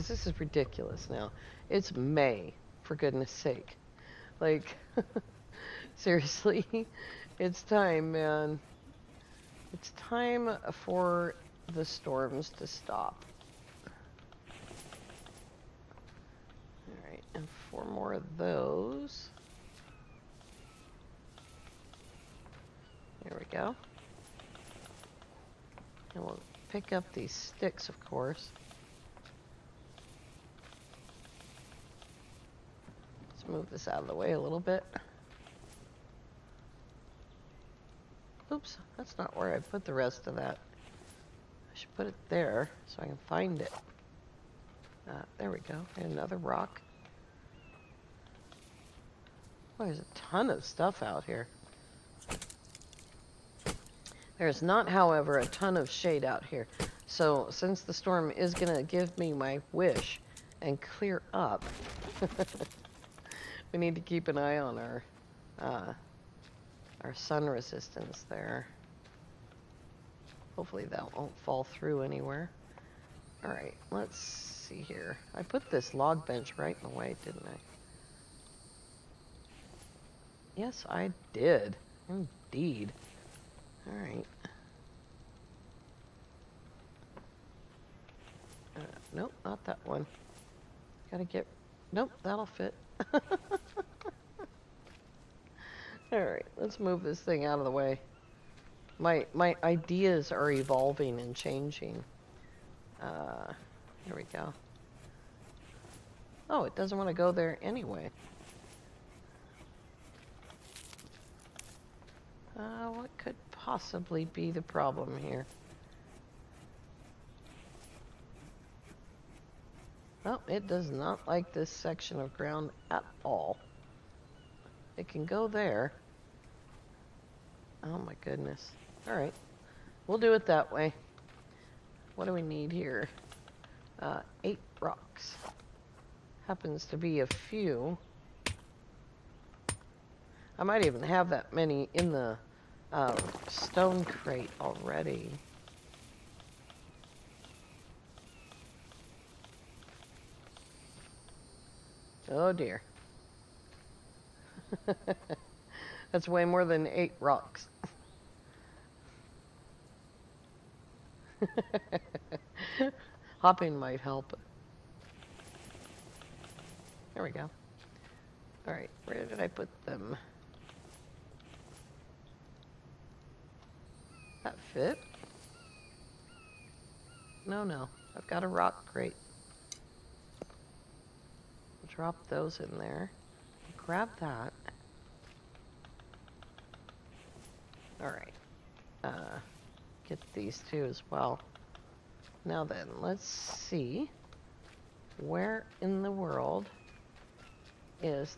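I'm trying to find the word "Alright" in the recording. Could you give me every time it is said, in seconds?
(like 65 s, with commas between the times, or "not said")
16 s, 96 s, 168 s, 188 s.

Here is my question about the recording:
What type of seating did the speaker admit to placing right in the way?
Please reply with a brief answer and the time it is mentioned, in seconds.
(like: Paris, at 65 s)
log bench, at 75 s.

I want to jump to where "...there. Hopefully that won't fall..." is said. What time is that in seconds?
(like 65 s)
68 s.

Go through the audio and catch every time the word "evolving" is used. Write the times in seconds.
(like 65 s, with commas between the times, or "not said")
100 s.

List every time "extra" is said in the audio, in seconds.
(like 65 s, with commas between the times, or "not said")
not said.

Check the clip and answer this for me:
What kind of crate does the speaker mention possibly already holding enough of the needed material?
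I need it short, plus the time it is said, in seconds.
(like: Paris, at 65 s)
stone crate, at 143 s.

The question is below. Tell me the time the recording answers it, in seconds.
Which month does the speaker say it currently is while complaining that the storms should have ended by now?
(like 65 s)
1 s.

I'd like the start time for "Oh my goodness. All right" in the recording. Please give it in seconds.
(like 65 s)
127 s.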